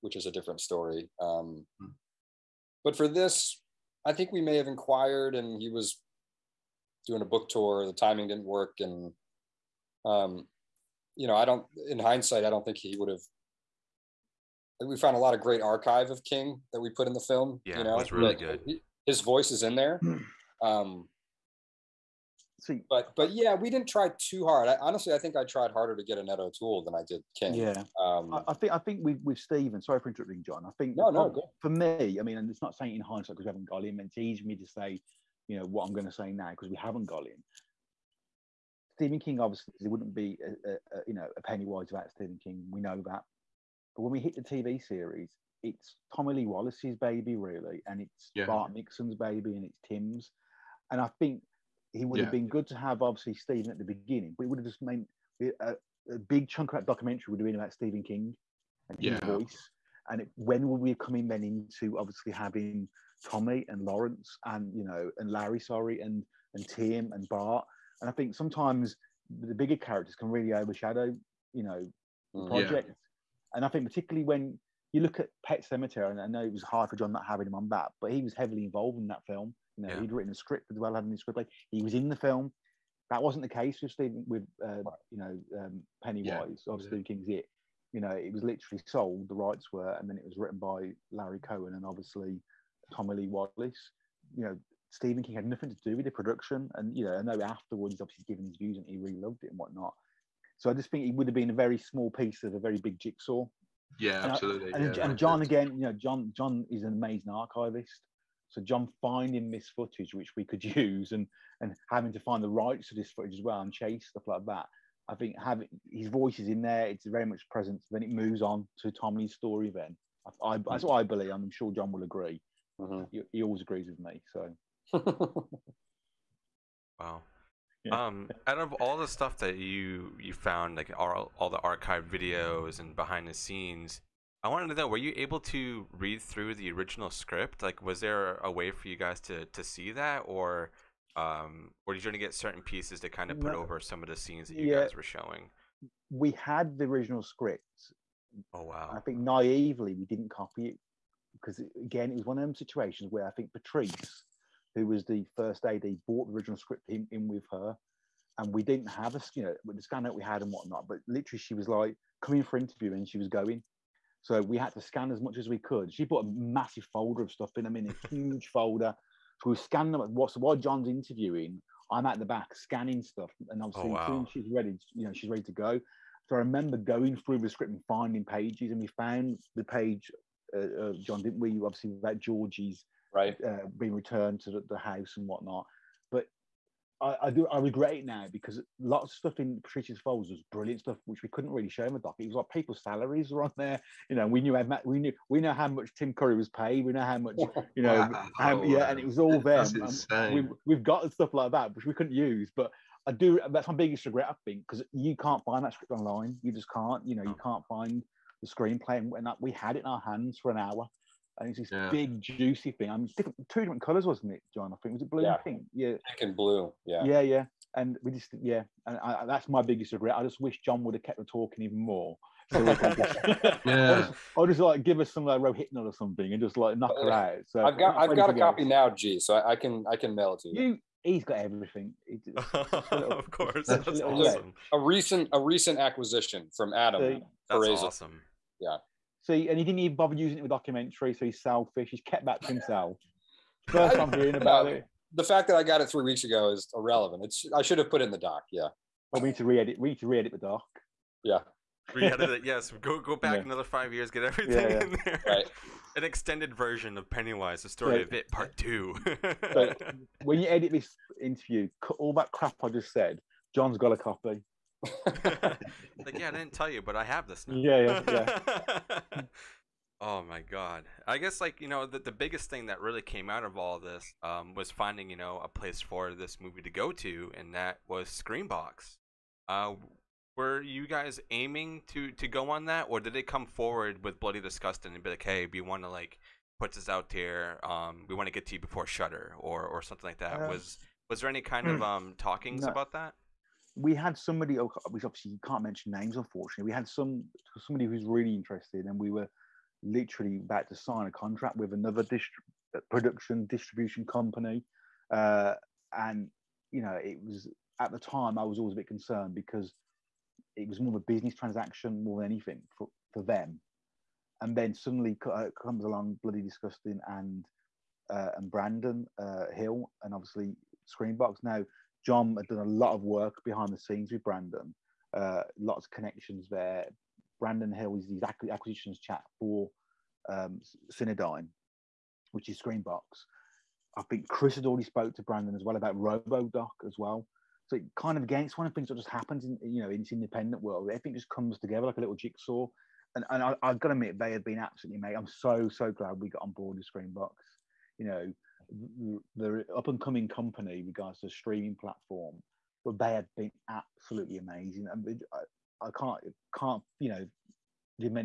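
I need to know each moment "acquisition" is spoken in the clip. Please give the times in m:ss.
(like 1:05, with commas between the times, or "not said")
3:55, 5:28.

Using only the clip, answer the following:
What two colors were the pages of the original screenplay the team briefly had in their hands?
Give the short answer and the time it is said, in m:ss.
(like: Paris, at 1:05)
Pink and blue, at 3:35.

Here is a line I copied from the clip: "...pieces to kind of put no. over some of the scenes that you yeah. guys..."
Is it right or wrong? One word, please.
right.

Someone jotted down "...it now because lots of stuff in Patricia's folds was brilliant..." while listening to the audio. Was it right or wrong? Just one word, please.
right.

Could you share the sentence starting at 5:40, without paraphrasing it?
Everything just comes together like a little jigsaw.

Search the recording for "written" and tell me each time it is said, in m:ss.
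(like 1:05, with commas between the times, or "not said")
1:20, 1:30.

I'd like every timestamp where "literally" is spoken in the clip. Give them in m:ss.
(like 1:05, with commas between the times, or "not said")
1:28, 2:41, 4:59.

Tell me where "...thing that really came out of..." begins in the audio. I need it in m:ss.
4:32.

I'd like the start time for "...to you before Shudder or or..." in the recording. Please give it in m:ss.
4:48.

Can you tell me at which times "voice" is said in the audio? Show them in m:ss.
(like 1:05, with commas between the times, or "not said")
0:19, 0:59, 1:56.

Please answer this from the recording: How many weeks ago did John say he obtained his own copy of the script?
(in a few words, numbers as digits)
3.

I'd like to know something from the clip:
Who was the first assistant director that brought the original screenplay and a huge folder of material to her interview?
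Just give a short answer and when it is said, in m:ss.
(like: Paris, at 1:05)
Patrice, at 2:33.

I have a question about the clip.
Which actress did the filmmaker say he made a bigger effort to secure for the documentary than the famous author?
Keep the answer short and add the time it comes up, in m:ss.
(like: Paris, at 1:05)
Annette O'Toole, at 0:26.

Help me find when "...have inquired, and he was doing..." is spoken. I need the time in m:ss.
0:04.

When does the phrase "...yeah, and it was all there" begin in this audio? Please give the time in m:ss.
3:18.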